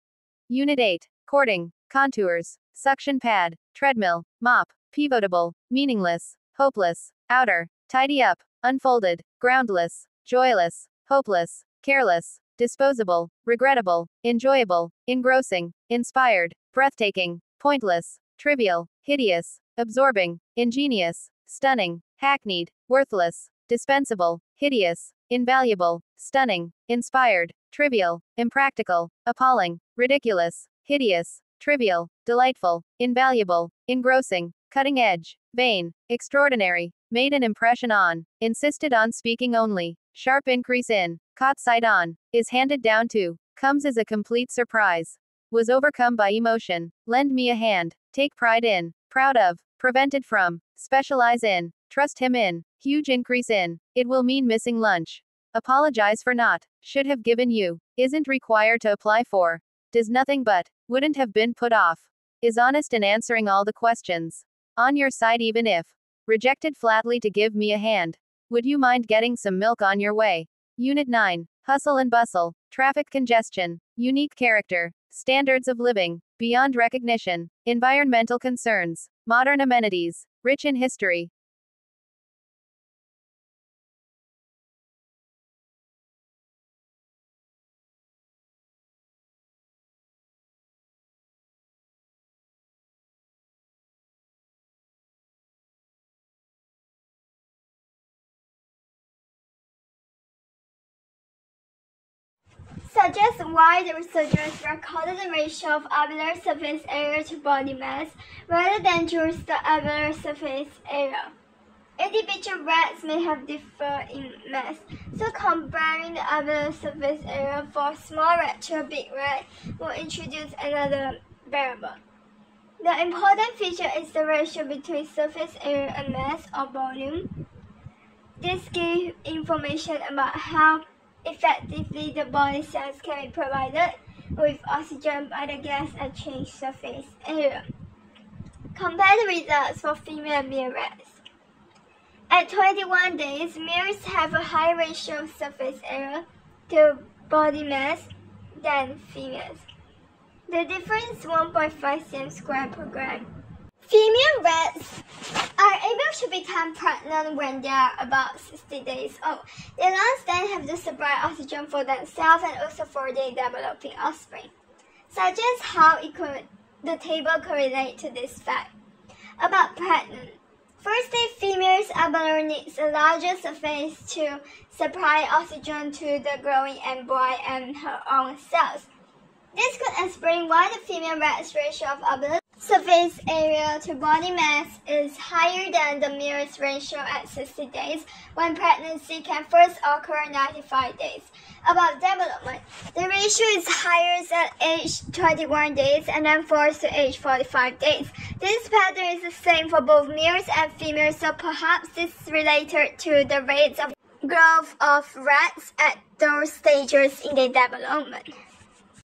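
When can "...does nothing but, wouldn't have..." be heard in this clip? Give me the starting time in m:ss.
0:59.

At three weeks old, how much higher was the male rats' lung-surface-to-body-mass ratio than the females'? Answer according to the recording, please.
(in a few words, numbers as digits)
1.5 cm² per gram.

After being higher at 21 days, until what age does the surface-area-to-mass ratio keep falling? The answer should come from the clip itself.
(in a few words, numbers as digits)
45 days.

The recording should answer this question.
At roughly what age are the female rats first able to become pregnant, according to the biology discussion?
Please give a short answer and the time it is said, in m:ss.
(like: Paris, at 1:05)
60 days, at 2:37.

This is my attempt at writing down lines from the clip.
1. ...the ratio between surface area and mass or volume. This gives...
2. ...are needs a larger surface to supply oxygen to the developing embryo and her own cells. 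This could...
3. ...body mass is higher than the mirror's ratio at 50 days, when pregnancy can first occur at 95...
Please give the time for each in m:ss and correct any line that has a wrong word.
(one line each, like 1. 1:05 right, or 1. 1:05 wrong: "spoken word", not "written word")
1. 2:04 right
2. 2:51 wrong: "growing", not "developing"
3. 3:03 wrong: "60", not "50".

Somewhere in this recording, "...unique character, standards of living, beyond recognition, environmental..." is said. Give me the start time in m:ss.
1:13.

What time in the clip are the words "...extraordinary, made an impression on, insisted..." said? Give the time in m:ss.
0:36.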